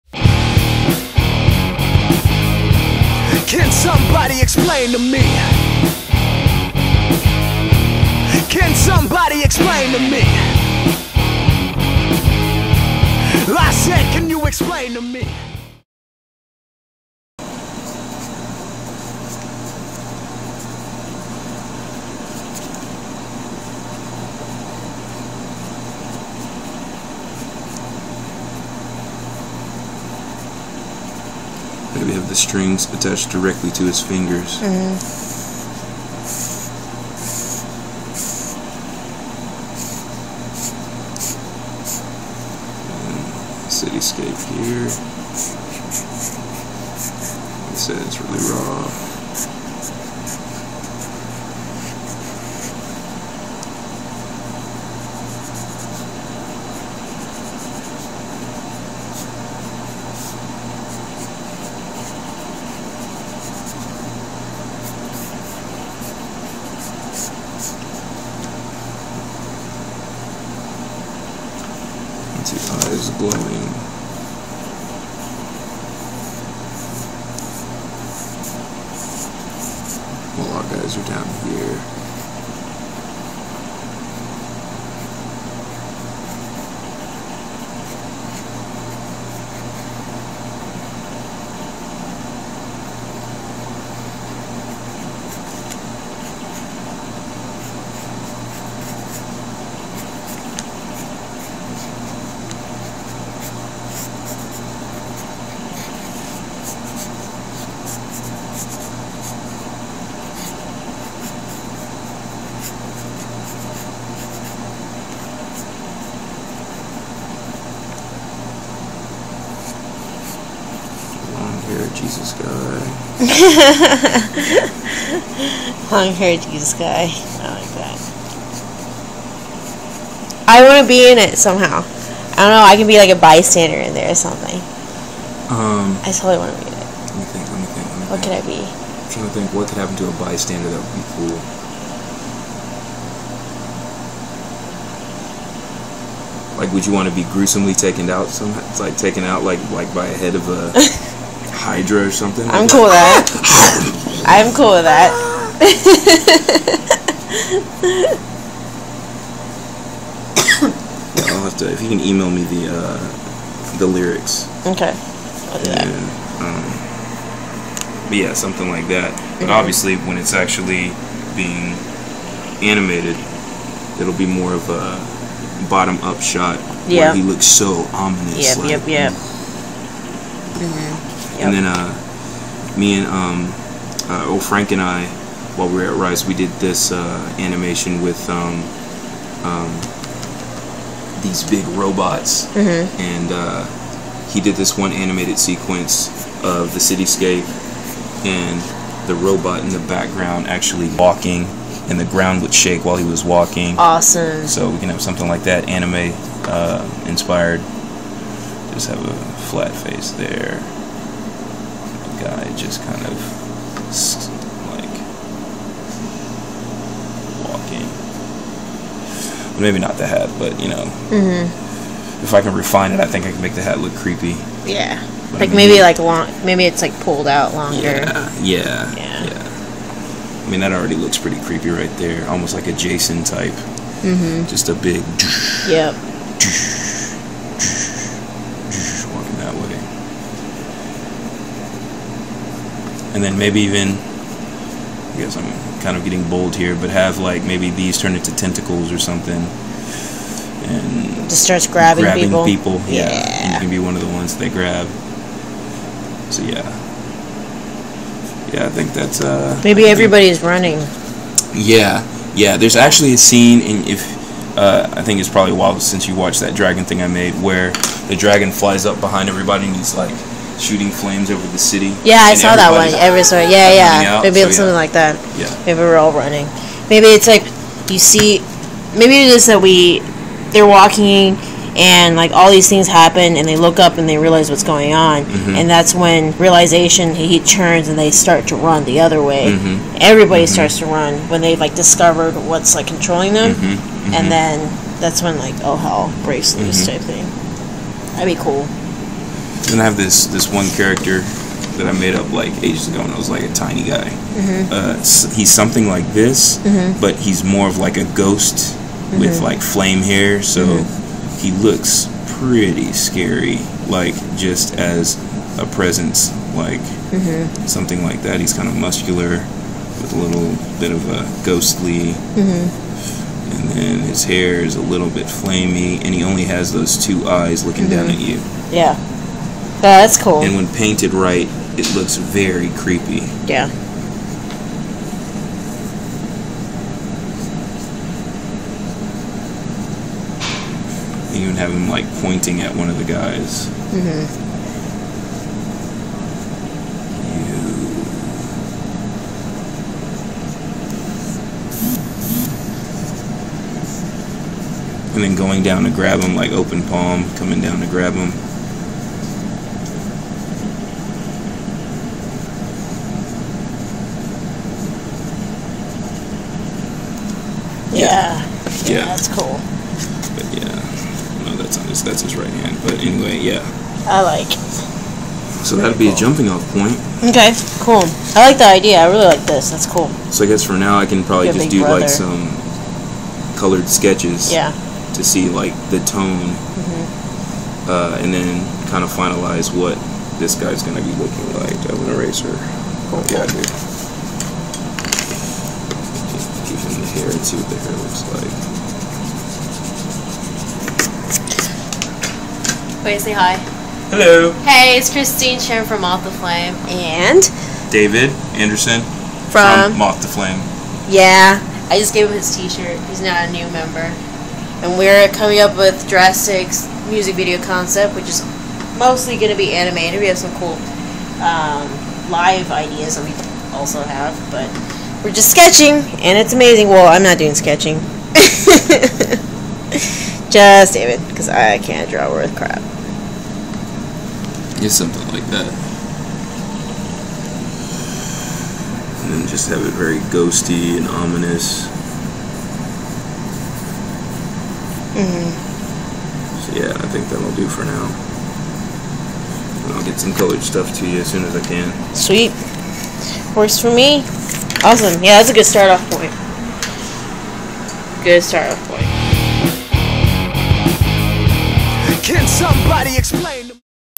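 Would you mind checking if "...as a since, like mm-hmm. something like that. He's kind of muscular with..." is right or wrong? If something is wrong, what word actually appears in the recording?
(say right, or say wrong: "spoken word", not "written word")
wrong: "presence", not "since".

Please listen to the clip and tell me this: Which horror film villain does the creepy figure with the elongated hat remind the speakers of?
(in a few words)
Jason.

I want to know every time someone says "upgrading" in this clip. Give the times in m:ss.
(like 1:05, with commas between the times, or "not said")
not said.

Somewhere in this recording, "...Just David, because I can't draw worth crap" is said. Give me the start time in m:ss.
7:10.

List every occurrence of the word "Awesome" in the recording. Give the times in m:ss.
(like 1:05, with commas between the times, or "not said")
3:23, 7:34.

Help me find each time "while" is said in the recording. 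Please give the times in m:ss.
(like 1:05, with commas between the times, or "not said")
3:05, 3:22, 4:25.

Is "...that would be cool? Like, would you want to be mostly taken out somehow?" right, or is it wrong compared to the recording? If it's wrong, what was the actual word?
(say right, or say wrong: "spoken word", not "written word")
wrong: "gruesomely", not "mostly".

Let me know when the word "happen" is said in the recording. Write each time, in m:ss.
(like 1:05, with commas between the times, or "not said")
2:19, 4:42.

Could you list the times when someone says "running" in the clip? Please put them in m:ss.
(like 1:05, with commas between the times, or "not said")
4:20, 4:36.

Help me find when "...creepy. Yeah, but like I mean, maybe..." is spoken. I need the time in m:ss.
3:43.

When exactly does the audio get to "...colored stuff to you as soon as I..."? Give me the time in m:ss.
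7:30.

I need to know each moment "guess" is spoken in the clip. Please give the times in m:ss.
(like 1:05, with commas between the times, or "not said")
4:05, 6:20.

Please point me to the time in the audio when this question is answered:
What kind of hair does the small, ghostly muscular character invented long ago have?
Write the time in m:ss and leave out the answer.
5:09.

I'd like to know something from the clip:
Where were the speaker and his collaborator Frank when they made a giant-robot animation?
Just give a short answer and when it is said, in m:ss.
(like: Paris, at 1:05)
Rice, at 3:05.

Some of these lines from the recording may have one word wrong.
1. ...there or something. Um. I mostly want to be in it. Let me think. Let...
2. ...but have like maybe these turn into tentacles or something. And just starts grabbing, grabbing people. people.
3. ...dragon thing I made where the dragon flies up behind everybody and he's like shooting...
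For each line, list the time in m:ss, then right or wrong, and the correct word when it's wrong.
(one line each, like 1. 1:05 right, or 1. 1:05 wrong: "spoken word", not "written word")
1. 2:13 wrong: "totally", not "mostly"
2. 4:06 right
3. 4:26 right.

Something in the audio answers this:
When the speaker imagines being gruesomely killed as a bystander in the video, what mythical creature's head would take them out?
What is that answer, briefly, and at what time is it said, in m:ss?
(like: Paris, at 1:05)
Hydra, at 2:31.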